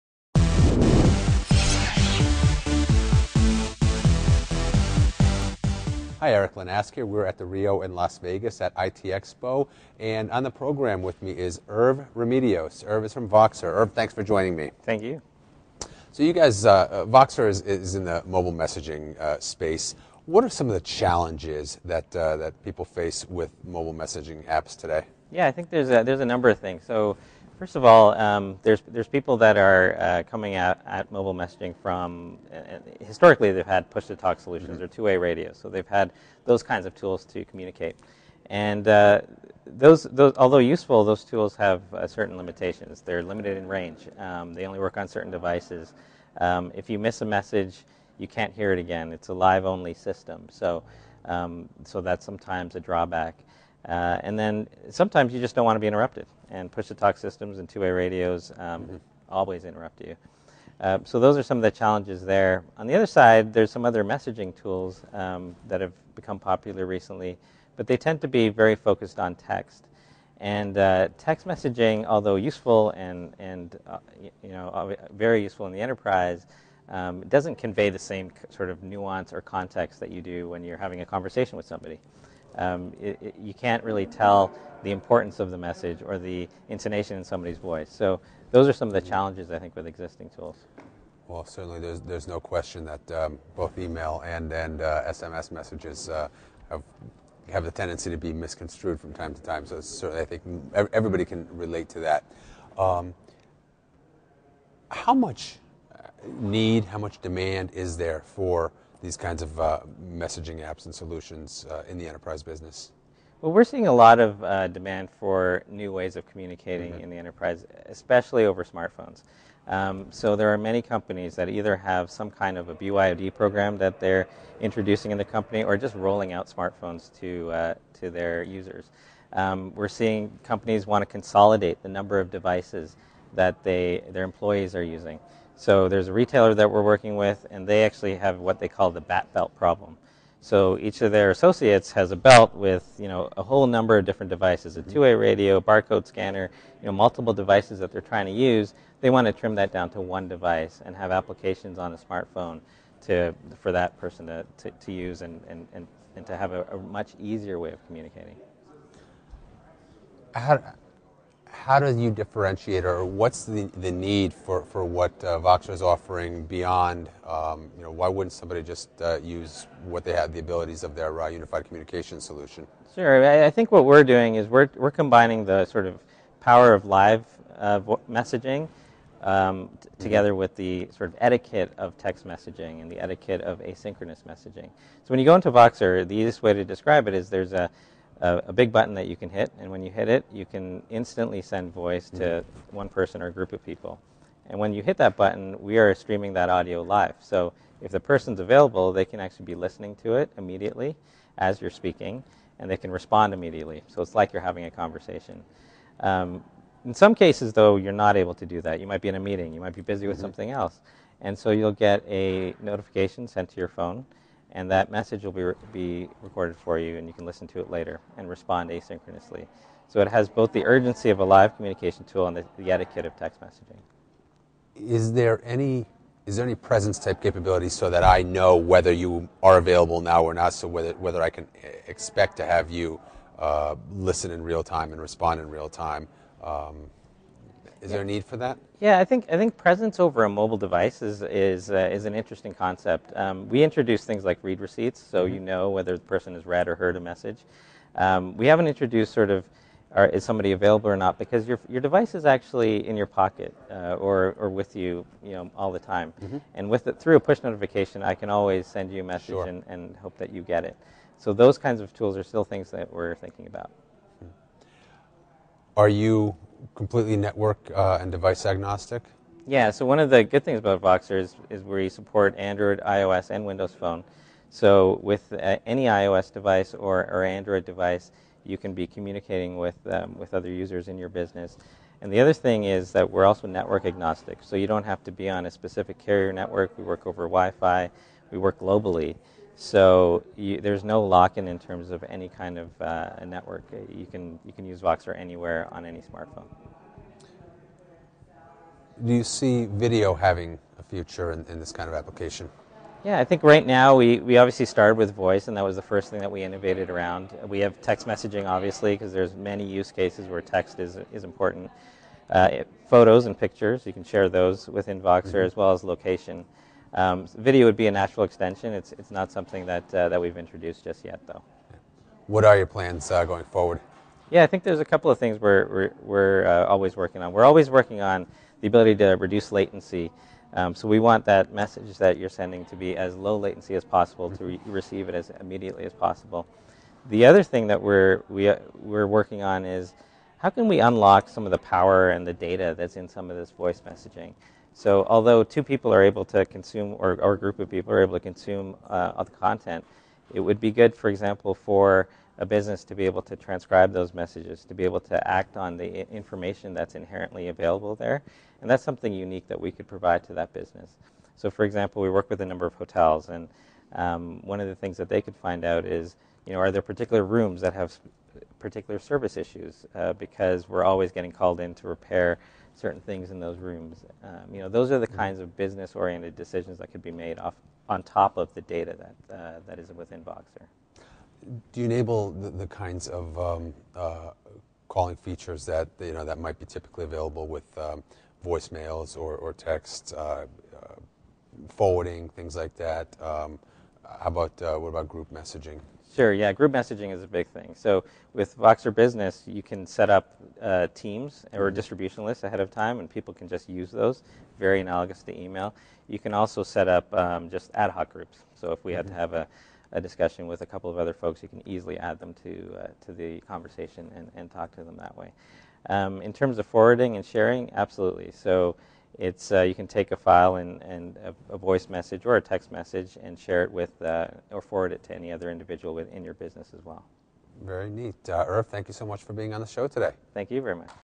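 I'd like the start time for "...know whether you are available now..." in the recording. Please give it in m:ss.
3:48.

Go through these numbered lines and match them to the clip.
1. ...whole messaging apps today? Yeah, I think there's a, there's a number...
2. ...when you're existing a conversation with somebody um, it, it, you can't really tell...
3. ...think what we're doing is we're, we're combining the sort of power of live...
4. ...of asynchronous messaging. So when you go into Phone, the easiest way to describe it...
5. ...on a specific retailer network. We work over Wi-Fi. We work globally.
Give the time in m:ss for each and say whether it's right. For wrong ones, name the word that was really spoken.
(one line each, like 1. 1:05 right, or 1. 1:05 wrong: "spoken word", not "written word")
1. 0:23 wrong: "mobile", not "whole"
2. 1:20 wrong: "having", not "existing"
3. 2:53 right
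4. 3:03 wrong: "Voxer", not "Phone"
5. 4:45 wrong: "carrier", not "retailer".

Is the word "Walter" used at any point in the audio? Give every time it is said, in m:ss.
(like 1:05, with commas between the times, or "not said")
not said.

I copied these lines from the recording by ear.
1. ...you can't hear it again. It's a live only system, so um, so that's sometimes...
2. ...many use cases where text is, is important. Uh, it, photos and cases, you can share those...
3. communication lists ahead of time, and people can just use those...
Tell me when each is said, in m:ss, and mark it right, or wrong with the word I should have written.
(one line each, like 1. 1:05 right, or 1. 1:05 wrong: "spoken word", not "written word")
1. 0:48 right
2. 5:09 wrong: "pictures", not "cases"
3. 6:41 wrong: "distribution", not "communication".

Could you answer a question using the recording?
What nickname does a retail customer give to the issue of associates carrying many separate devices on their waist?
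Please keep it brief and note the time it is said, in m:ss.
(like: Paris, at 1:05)
Bat belt problem, at 2:18.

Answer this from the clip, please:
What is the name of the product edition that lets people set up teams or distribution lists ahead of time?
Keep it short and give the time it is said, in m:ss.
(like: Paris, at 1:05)
Voxer Business, at 6:38.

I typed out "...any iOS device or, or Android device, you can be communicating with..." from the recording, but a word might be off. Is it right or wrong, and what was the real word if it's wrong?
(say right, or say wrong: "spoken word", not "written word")
right.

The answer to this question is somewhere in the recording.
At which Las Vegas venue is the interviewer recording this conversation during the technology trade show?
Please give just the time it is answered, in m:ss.
0:07.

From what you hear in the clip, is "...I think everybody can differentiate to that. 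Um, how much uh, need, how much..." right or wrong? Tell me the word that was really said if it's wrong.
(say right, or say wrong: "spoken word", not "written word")
wrong: "relate", not "differentiate".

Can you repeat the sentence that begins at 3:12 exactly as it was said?
one person or group of people.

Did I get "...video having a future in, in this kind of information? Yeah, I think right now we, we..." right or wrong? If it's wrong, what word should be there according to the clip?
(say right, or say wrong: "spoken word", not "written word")
wrong: "application", not "information".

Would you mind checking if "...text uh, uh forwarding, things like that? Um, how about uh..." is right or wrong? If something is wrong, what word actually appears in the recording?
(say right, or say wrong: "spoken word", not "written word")
right.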